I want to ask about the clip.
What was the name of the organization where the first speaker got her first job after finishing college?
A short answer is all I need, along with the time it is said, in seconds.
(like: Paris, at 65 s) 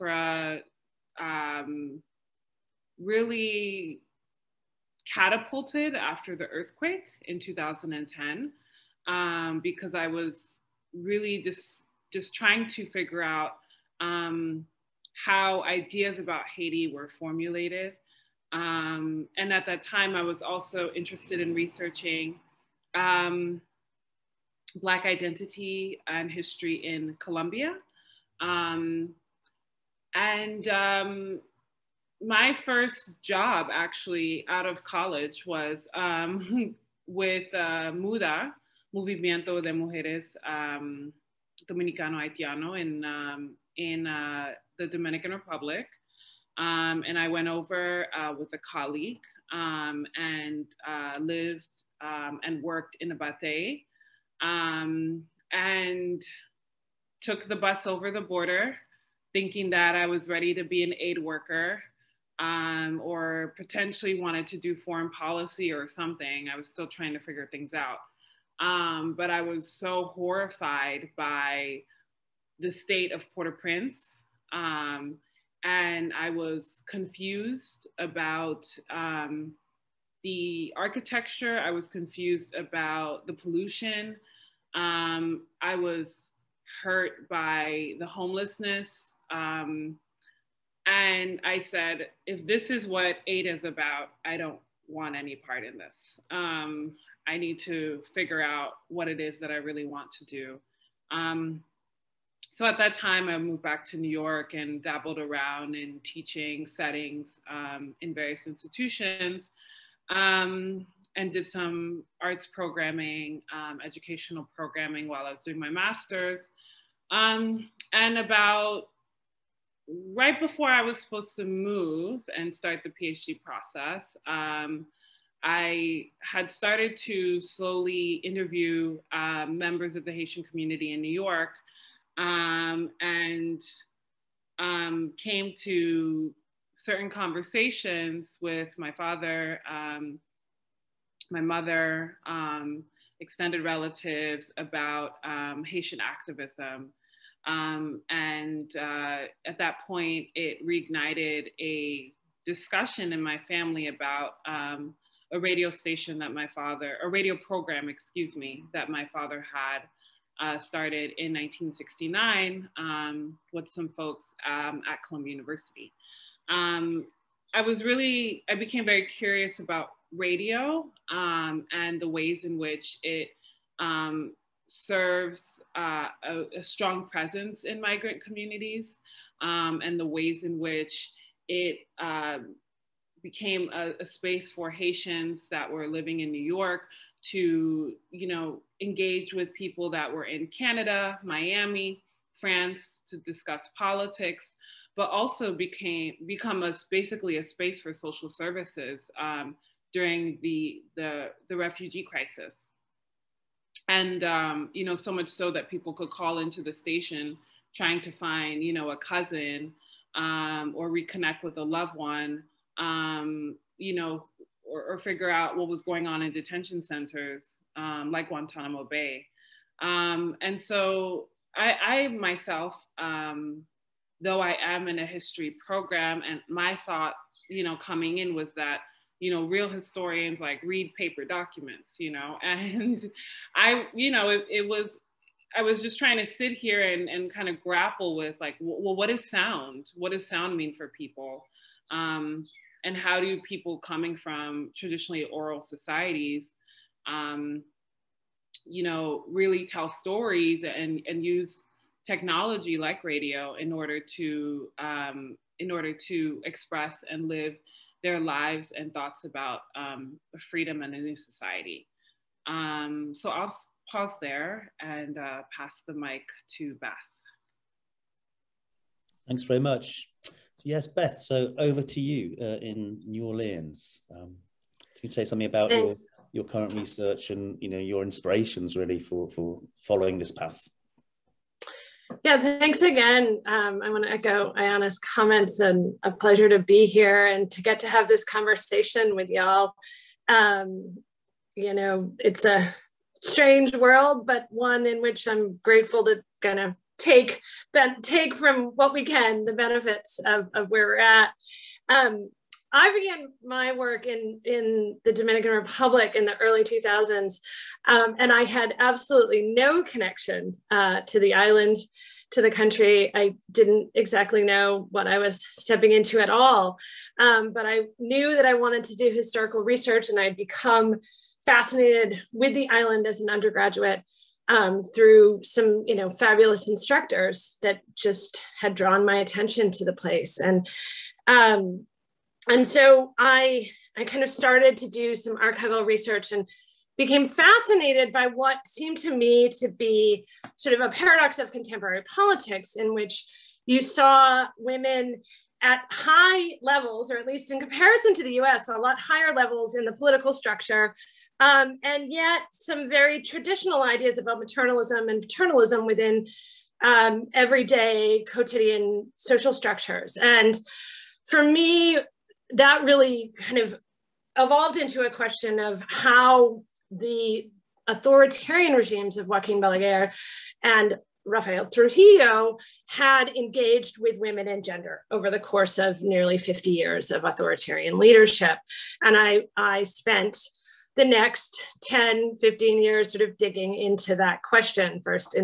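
MUDHA, at 37 s.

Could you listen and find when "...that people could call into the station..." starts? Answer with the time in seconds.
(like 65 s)
205 s.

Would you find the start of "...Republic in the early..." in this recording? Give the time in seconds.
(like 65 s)
305 s.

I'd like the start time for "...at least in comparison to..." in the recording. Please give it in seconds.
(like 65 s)
347 s.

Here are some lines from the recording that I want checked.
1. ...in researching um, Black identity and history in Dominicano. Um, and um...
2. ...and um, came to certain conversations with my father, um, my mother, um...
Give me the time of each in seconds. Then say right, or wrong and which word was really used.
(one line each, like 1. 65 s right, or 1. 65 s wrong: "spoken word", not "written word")
1. 21 s wrong: "Colombia", not "Dominicano"
2. 132 s right.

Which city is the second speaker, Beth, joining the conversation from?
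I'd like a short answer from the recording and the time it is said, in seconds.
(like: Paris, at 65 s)
New Orleans, at 273 s.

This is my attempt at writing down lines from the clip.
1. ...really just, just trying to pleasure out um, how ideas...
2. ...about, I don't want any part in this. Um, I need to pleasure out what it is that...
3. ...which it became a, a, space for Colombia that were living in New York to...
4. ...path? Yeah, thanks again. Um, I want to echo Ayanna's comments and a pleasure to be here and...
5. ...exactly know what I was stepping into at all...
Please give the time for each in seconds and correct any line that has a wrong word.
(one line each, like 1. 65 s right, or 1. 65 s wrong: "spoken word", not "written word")
1. 10 s wrong: "figure", not "pleasure"
2. 93 s wrong: "figure", not "pleasure"
3. 180 s wrong: "Haitians", not "Colombia"
4. 280 s right
5. 313 s right.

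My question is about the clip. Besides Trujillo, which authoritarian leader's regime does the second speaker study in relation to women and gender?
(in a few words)
Joaquin Balaguer.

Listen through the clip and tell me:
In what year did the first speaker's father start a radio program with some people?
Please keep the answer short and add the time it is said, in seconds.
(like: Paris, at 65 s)
1969, at 161 s.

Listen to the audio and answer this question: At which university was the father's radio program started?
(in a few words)
Columbia University.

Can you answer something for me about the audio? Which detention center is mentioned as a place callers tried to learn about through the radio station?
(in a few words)
Guantanamo Bay.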